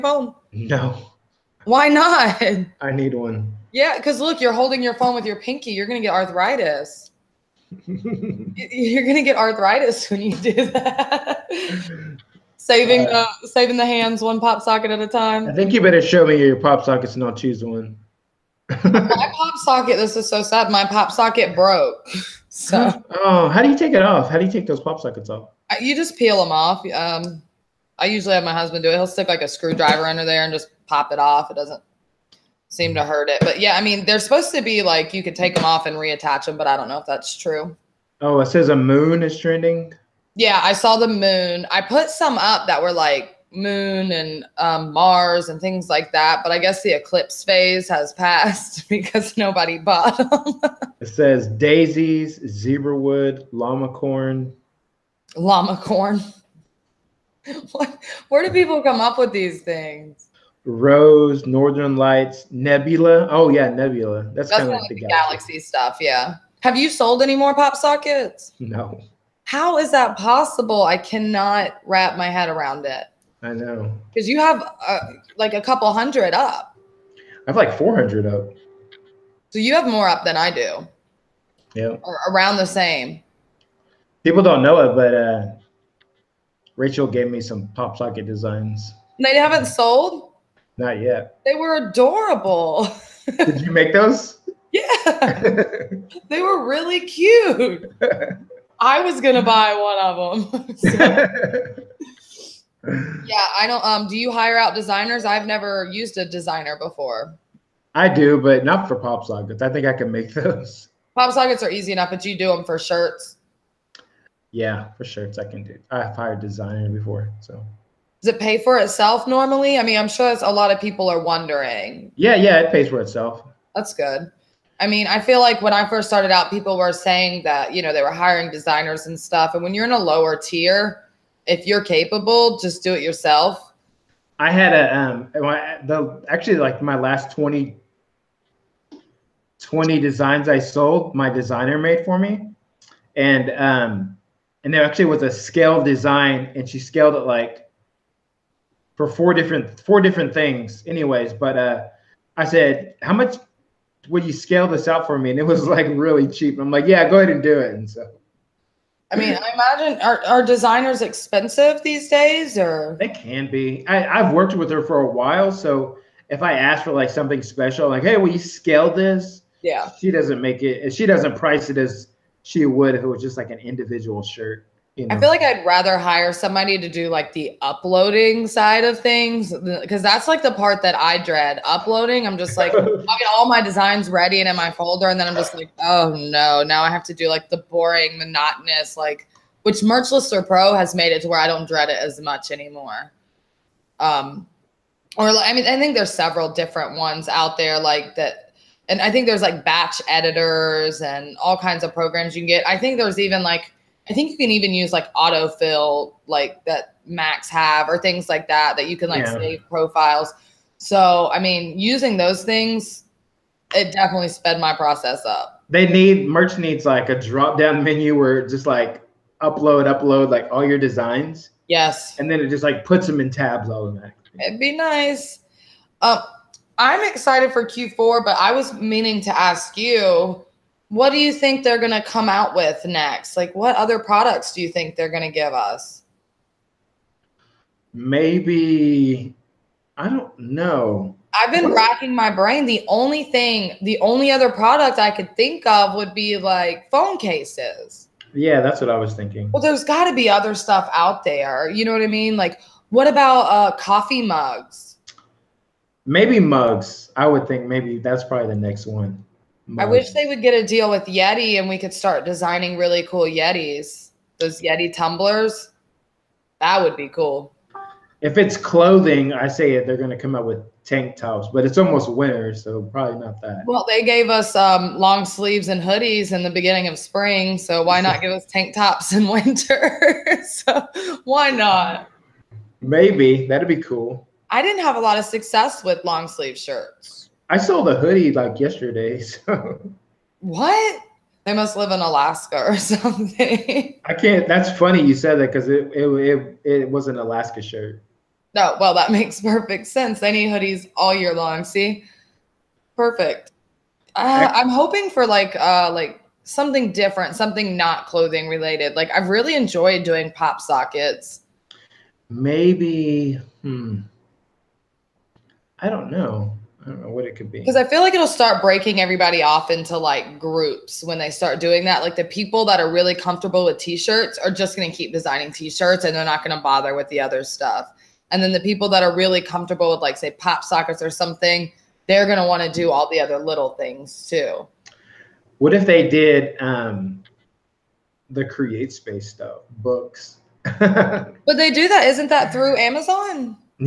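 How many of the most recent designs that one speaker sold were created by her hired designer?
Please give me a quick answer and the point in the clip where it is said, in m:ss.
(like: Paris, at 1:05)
20, at 2:19.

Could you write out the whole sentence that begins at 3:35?
They need merch needs like a drop down menu where just like upload, upload like all your designs.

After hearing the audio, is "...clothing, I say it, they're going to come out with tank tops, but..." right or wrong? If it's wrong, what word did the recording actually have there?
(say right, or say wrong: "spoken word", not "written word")
right.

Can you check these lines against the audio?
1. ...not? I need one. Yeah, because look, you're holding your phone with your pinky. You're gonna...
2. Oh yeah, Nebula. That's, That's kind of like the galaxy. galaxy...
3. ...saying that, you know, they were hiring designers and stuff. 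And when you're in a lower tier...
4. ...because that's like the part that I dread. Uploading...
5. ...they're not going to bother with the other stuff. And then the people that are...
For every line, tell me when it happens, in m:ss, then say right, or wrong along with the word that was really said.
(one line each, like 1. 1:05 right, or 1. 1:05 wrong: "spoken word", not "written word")
1. 0:01 right
2. 1:03 right
3. 2:06 right
4. 2:59 right
5. 5:26 right.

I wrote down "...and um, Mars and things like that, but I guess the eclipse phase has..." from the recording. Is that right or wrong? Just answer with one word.
right.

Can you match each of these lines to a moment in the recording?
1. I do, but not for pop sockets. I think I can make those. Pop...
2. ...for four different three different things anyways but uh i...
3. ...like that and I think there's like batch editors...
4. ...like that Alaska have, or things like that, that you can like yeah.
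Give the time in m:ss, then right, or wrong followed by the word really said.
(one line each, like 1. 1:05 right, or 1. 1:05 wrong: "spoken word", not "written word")
1. 1:47 right
2. 2:28 wrong: "four", not "three"
3. 3:17 right
4. 3:26 wrong: "Macs", not "Alaska".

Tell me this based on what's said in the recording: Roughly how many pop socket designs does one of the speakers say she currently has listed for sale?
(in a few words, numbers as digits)
400.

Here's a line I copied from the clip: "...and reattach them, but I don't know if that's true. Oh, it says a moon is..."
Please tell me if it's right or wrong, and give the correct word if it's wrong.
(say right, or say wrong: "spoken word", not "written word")
right.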